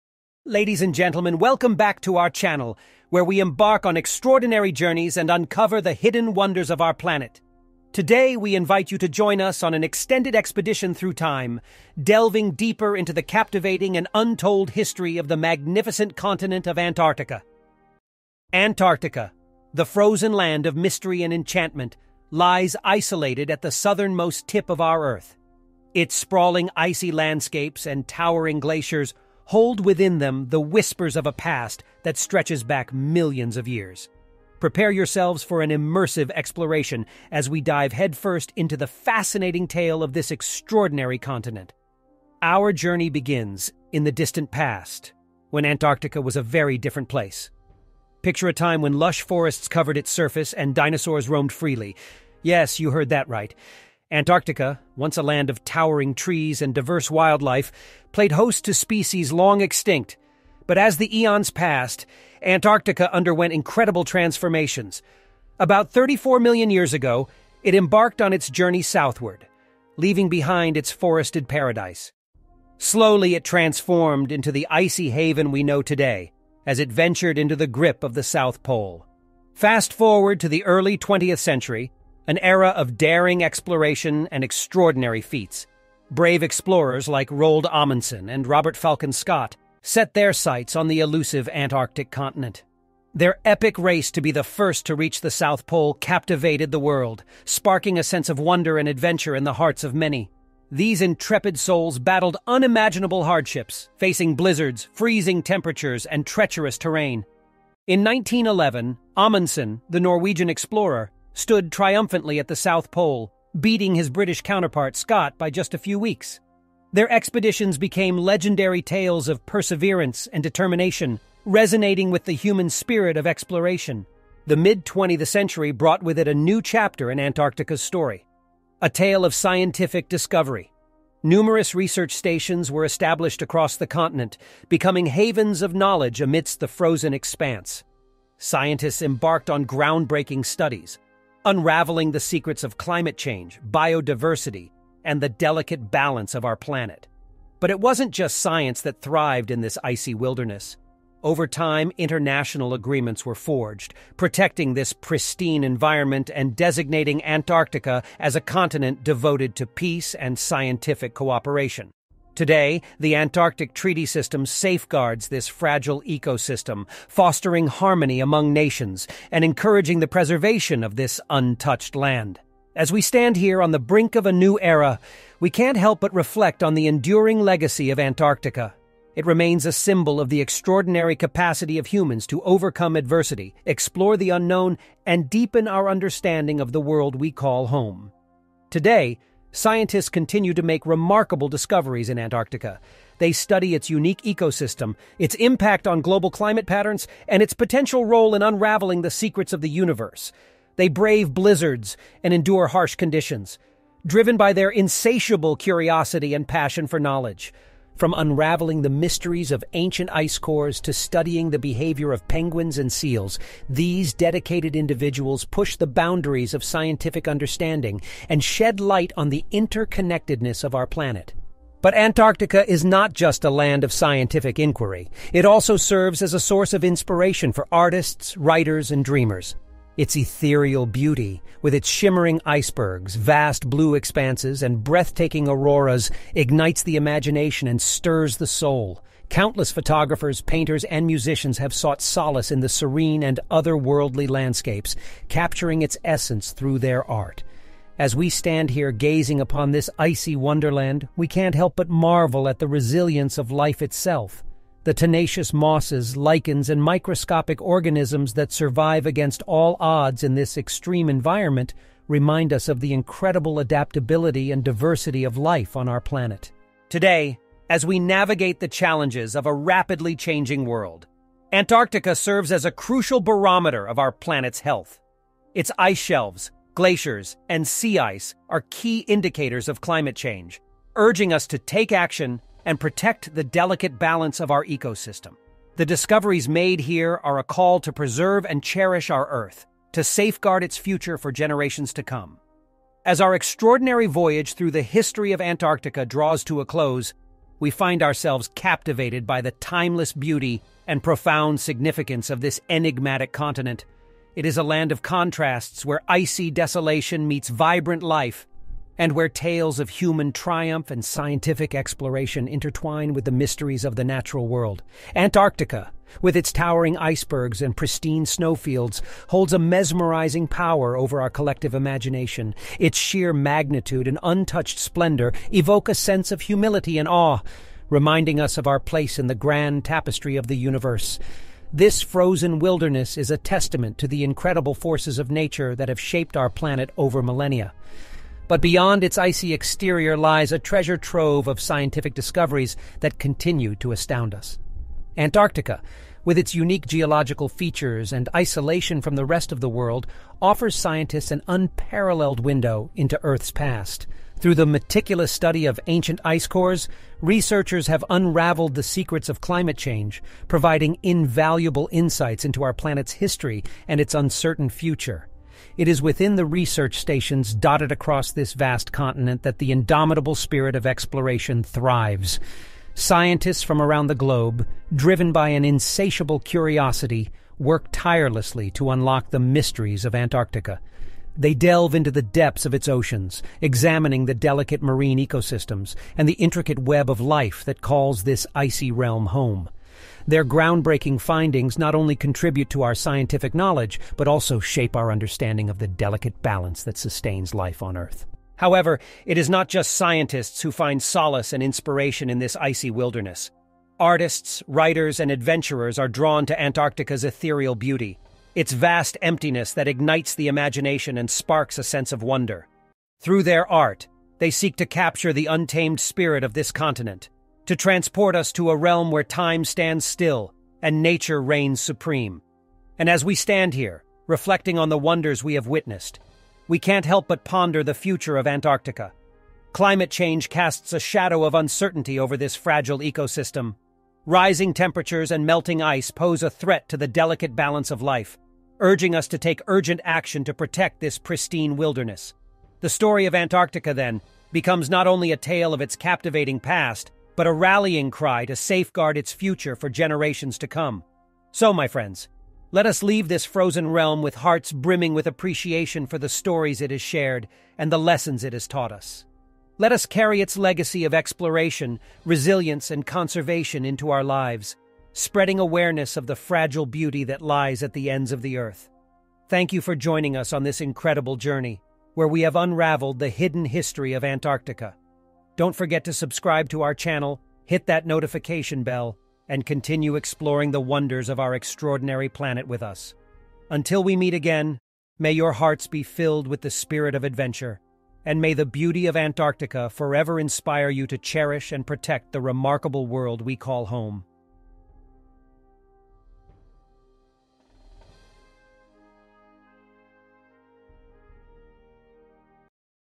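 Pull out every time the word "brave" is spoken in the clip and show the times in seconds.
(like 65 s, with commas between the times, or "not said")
86 s, 200 s.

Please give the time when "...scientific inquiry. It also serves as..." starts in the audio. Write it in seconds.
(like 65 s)
223 s.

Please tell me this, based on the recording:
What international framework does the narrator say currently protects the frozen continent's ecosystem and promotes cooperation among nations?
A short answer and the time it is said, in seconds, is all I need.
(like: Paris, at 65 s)
Antarctic Treaty System, at 162 s.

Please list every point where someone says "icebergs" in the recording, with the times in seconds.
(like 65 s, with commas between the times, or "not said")
232 s, 316 s.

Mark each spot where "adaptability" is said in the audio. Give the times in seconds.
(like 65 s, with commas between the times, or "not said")
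263 s.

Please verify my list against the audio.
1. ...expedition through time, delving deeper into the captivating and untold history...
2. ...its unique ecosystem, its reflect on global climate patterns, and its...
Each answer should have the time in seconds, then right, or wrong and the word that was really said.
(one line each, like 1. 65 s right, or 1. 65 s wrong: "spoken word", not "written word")
1. 10 s right
2. 193 s wrong: "impact", not "reflect".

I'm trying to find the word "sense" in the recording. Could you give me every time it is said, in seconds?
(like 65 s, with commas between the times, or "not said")
98 s, 325 s, 411 s.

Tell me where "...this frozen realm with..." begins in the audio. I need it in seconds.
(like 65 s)
453 s.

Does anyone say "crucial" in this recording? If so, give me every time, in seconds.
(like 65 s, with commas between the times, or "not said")
272 s.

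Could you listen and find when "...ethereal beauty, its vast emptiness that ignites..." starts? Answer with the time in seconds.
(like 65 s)
407 s.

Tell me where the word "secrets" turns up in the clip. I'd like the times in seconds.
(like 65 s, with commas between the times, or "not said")
142 s, 199 s, 358 s.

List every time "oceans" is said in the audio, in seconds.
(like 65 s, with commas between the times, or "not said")
382 s.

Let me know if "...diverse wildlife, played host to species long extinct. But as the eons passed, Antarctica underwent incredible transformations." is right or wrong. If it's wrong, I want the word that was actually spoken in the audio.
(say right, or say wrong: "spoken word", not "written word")
right.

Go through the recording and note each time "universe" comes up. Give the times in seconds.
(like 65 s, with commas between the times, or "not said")
199 s, 330 s.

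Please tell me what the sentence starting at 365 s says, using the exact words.
It is within the research stations dotted across this vast continent that the indomitable spirit of exploration thrives.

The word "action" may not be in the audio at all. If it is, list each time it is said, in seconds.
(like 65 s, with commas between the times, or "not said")
281 s, 440 s.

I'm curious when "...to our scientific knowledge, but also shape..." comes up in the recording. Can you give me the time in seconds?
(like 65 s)
392 s.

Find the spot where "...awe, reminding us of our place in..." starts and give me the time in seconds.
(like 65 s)
327 s.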